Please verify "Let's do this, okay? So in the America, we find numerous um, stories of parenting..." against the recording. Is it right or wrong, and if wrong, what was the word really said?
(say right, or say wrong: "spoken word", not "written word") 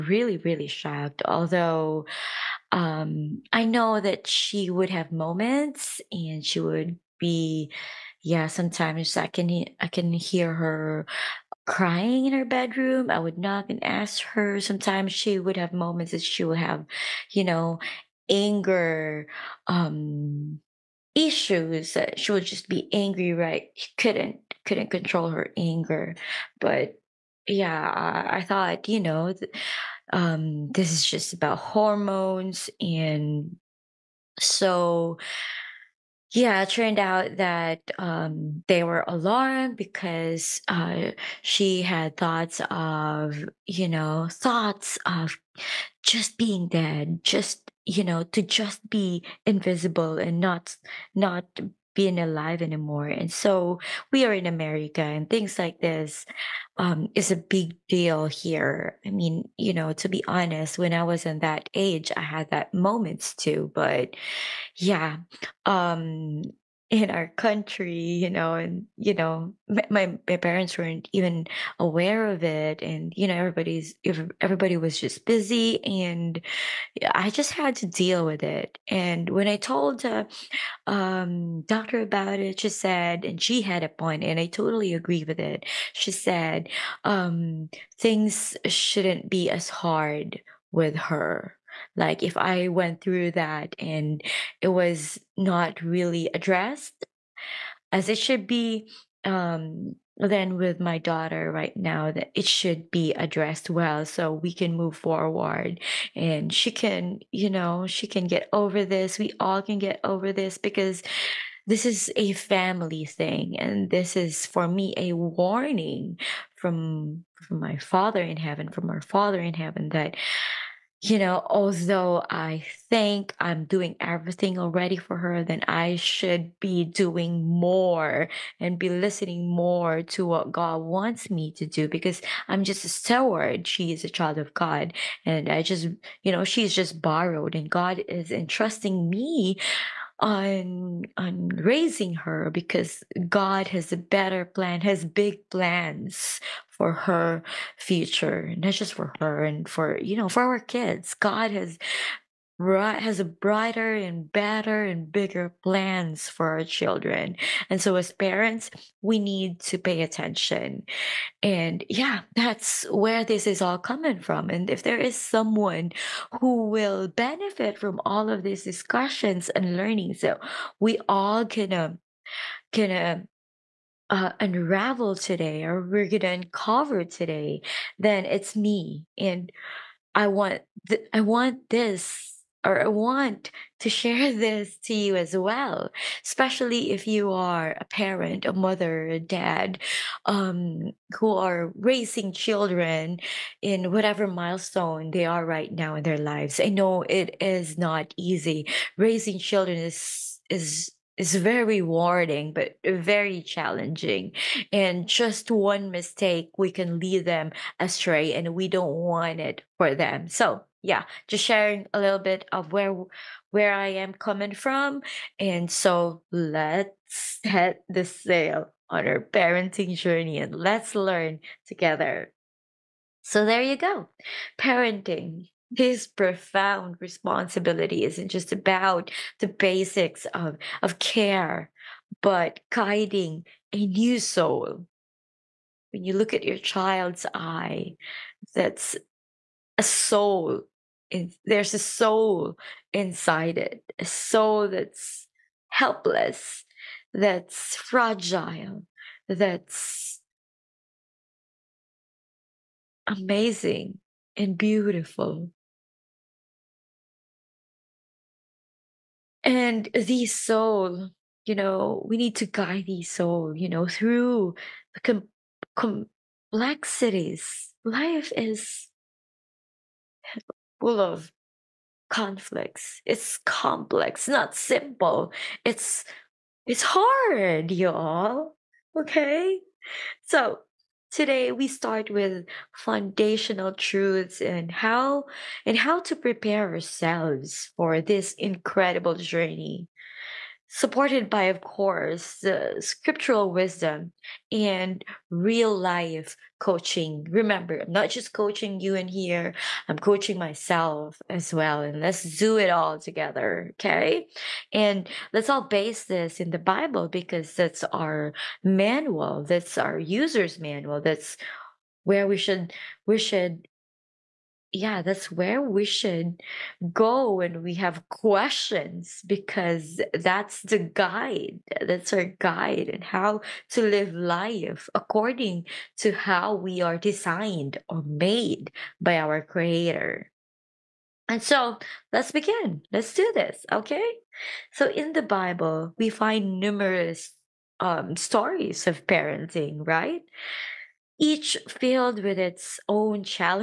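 wrong: "Bible", not "America".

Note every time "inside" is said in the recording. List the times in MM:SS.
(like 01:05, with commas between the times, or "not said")
04:02.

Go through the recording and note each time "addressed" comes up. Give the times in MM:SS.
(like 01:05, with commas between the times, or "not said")
01:36, 01:43.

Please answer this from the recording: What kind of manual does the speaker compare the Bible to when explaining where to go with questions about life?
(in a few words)
user's manual.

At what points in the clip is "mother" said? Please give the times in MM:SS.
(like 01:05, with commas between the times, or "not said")
03:08.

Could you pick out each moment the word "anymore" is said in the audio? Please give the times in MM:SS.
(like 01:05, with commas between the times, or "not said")
00:52.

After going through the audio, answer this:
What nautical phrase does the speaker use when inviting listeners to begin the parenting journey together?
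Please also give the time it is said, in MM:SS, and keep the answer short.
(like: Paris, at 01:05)
set the sail, at 03:37.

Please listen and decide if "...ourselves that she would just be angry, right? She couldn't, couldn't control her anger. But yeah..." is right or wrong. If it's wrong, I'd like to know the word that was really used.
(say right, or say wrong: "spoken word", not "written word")
wrong: "issues", not "ourselves".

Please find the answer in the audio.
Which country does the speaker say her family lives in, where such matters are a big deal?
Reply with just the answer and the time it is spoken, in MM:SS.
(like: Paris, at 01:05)
America, at 00:54.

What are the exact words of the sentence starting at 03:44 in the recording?
Parenting this profound responsibility isn't just about the basics of, of care, but guiding a new soul.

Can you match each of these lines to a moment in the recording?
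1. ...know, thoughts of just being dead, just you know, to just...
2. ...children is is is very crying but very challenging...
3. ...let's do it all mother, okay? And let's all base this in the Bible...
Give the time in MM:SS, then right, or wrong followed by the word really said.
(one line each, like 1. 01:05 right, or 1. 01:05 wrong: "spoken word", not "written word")
1. 00:43 right
2. 03:19 wrong: "rewarding", not "crying"
3. 05:02 wrong: "together", not "mother".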